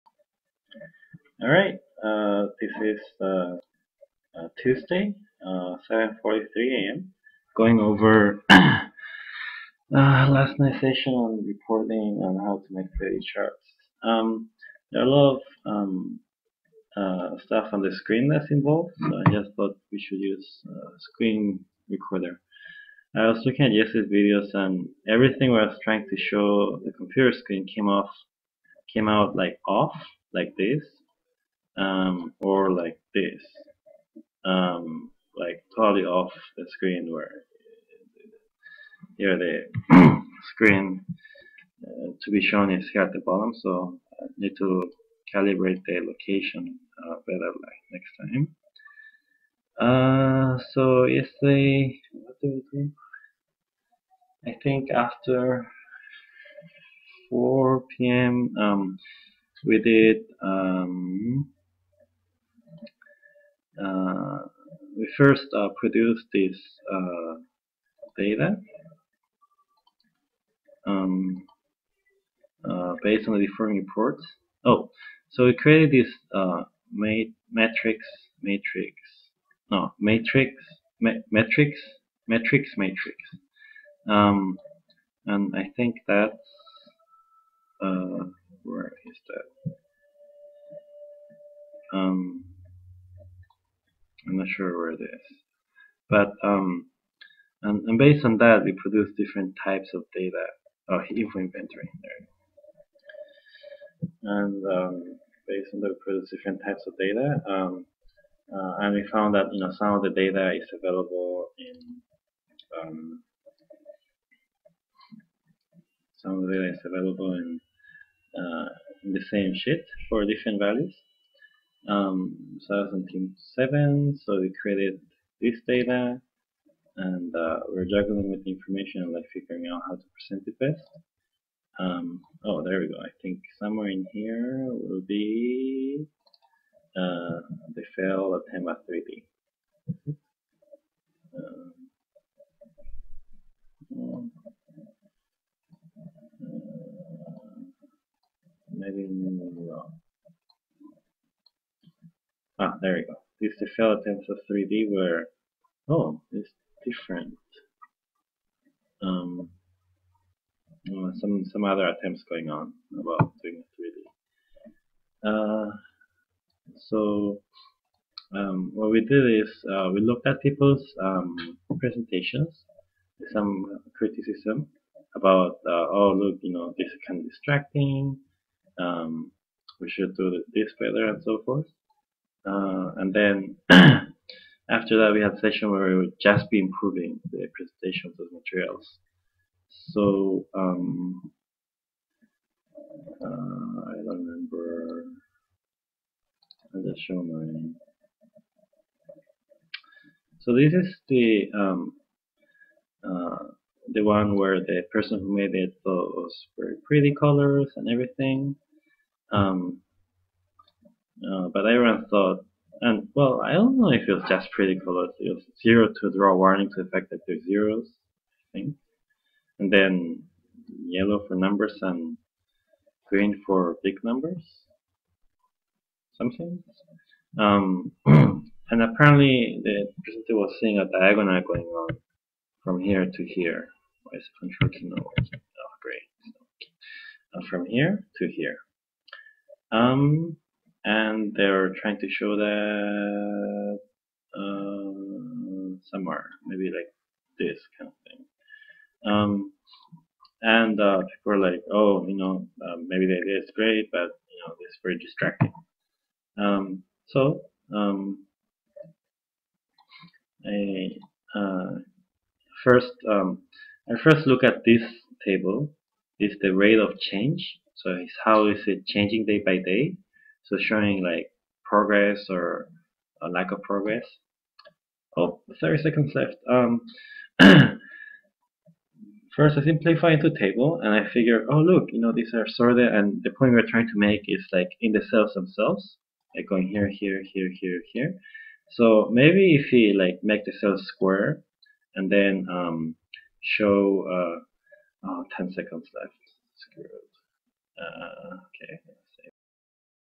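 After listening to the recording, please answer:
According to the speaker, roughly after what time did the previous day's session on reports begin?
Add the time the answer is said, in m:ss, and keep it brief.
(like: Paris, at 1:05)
4 p.m., at 0:57.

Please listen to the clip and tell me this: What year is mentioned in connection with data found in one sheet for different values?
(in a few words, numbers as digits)
2007.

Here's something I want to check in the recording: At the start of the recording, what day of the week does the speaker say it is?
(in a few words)
Tuesday.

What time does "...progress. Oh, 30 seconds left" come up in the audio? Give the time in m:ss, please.
4:33.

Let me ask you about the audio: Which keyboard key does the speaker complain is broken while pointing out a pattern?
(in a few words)
control key.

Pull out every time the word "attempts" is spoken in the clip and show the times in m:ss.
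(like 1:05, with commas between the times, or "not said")
2:18, 2:33, 2:41.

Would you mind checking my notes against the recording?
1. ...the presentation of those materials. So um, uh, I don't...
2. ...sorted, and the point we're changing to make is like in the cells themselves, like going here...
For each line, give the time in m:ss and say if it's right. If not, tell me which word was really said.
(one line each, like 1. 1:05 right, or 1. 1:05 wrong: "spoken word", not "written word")
1. 3:07 right
2. 4:42 wrong: "trying", not "changing".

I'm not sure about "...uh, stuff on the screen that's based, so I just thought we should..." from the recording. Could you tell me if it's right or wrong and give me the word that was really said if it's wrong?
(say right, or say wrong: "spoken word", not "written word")
wrong: "involved", not "based".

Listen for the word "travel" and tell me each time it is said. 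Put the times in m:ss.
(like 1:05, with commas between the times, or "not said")
not said.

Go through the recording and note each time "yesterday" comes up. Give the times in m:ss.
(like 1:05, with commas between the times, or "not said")
0:23, 0:51.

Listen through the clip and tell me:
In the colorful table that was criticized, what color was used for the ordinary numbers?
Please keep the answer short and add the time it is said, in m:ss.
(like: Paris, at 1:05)
yellow, at 3:40.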